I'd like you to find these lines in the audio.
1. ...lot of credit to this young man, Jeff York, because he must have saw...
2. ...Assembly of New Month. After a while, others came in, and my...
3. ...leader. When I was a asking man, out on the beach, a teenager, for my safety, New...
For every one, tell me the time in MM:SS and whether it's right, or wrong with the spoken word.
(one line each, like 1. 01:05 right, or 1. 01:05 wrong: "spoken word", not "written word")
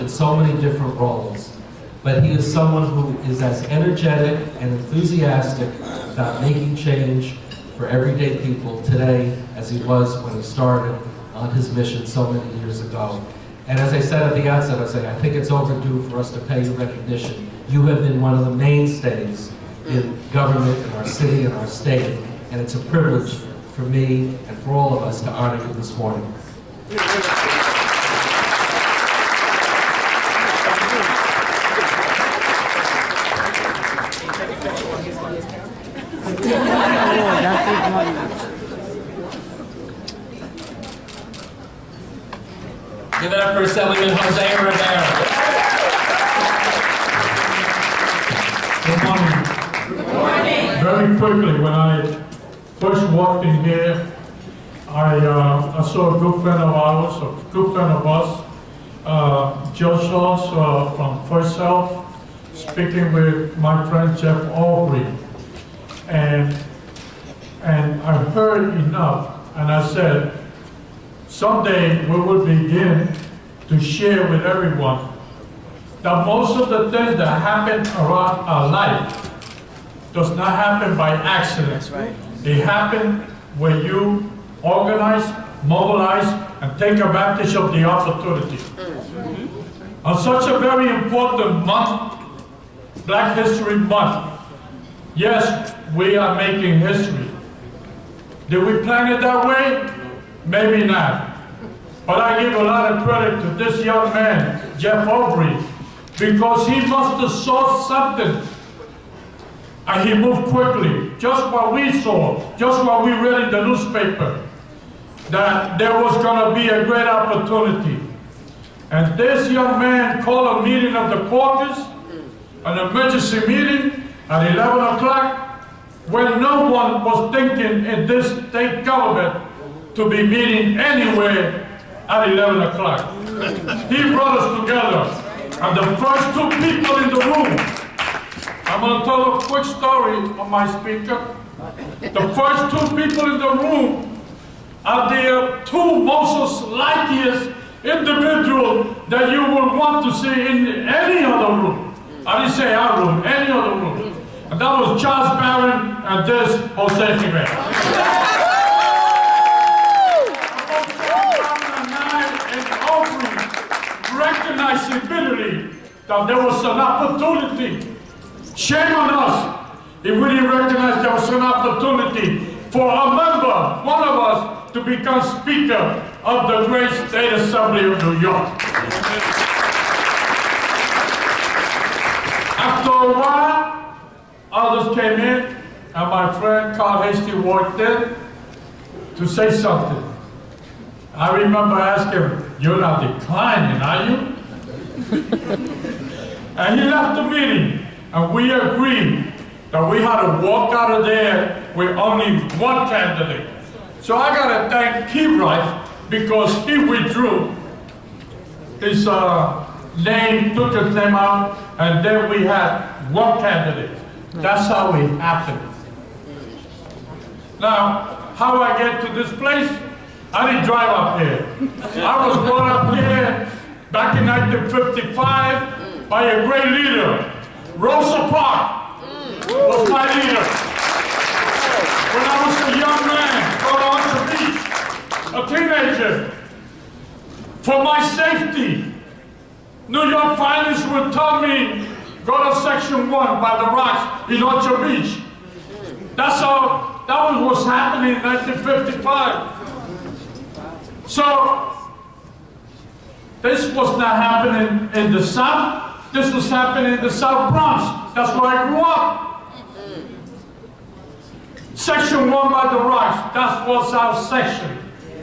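1. 01:42 wrong: "Aubry", not "York"
2. 02:57 wrong: "York", not "Month"
3. 03:50 wrong: "young", not "asking".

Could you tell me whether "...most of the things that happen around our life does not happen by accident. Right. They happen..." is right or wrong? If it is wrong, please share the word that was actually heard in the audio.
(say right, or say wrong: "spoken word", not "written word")
right.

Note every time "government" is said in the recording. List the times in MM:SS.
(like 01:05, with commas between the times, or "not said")
00:20, 02:08.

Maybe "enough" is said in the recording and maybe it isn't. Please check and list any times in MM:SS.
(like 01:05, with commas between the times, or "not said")
01:08.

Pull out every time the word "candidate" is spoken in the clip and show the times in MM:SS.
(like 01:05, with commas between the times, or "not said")
03:22, 03:33.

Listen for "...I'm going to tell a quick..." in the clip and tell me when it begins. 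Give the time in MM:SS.
02:18.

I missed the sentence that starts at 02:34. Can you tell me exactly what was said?
And that was Charles Barron and this Jose Rivera.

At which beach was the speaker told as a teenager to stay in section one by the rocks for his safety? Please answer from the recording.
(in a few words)
Orchard Beach.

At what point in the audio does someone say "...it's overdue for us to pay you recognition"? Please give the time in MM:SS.
00:15.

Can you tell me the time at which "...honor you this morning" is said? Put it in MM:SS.
00:25.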